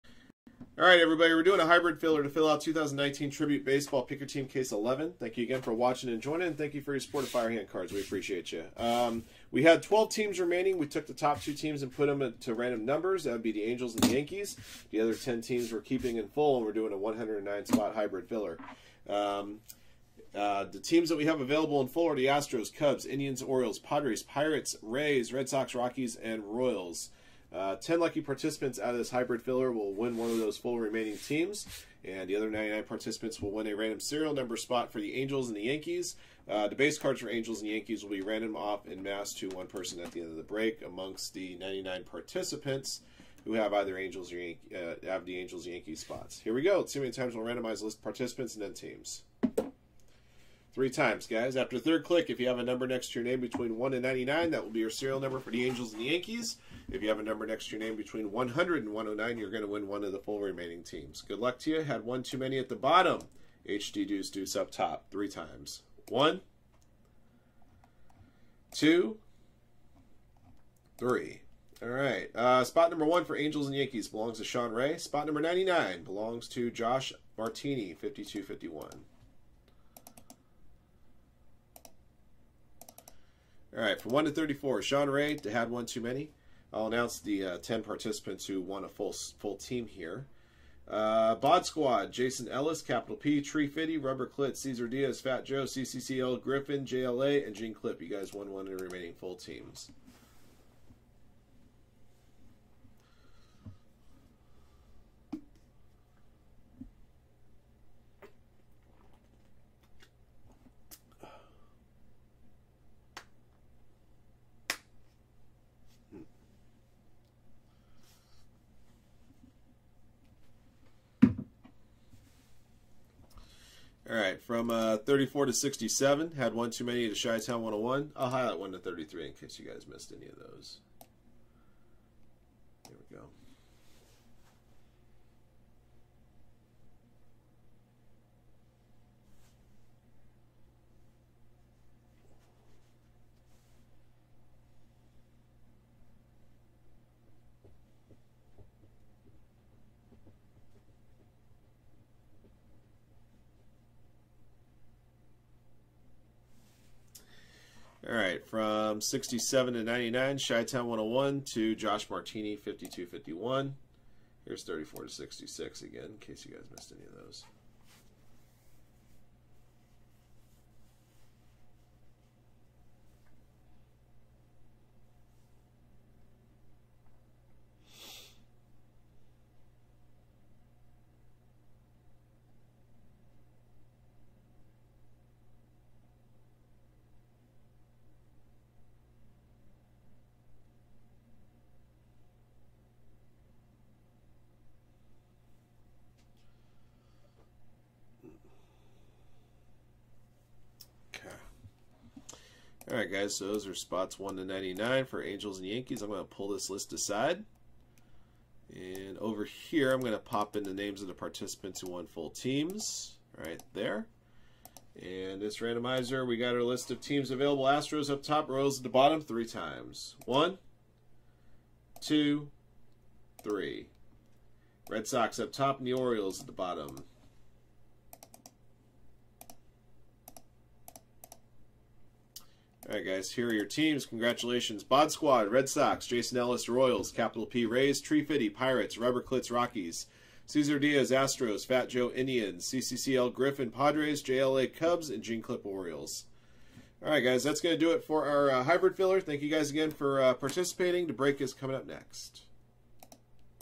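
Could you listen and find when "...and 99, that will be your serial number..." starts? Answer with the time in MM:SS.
00:53.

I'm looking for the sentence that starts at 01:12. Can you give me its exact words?
Uh, spot number one for Angels and Yankees belongs to Sean Ray.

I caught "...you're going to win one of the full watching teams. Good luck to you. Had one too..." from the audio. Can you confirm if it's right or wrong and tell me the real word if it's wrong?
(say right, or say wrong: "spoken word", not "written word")
wrong: "remaining", not "watching".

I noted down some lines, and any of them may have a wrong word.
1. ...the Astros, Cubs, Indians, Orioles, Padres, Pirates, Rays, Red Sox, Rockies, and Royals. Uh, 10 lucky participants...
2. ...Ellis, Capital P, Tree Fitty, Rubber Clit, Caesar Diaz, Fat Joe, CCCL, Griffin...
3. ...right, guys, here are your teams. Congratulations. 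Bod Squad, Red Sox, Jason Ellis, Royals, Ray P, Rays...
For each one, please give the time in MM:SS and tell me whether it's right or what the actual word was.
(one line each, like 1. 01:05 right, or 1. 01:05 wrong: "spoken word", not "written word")
1. 00:22 right
2. 01:32 right
3. 03:52 wrong: "Capital", not "Ray".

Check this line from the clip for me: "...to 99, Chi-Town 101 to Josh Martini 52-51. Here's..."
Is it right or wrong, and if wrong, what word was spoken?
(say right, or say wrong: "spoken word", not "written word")
right.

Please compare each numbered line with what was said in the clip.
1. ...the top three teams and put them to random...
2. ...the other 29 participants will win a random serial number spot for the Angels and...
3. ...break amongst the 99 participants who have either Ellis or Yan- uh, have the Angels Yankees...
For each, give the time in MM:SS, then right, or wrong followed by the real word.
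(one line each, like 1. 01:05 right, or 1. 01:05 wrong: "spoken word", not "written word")
1. 00:11 wrong: "two", not "three"
2. 00:32 wrong: "99", not "29"
3. 00:40 wrong: "Angels", not "Ellis".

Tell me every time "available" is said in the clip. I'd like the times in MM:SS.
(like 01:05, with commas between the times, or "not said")
00:21, 03:37.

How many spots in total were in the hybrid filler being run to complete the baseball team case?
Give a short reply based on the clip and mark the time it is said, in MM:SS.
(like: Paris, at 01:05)
109, at 00:16.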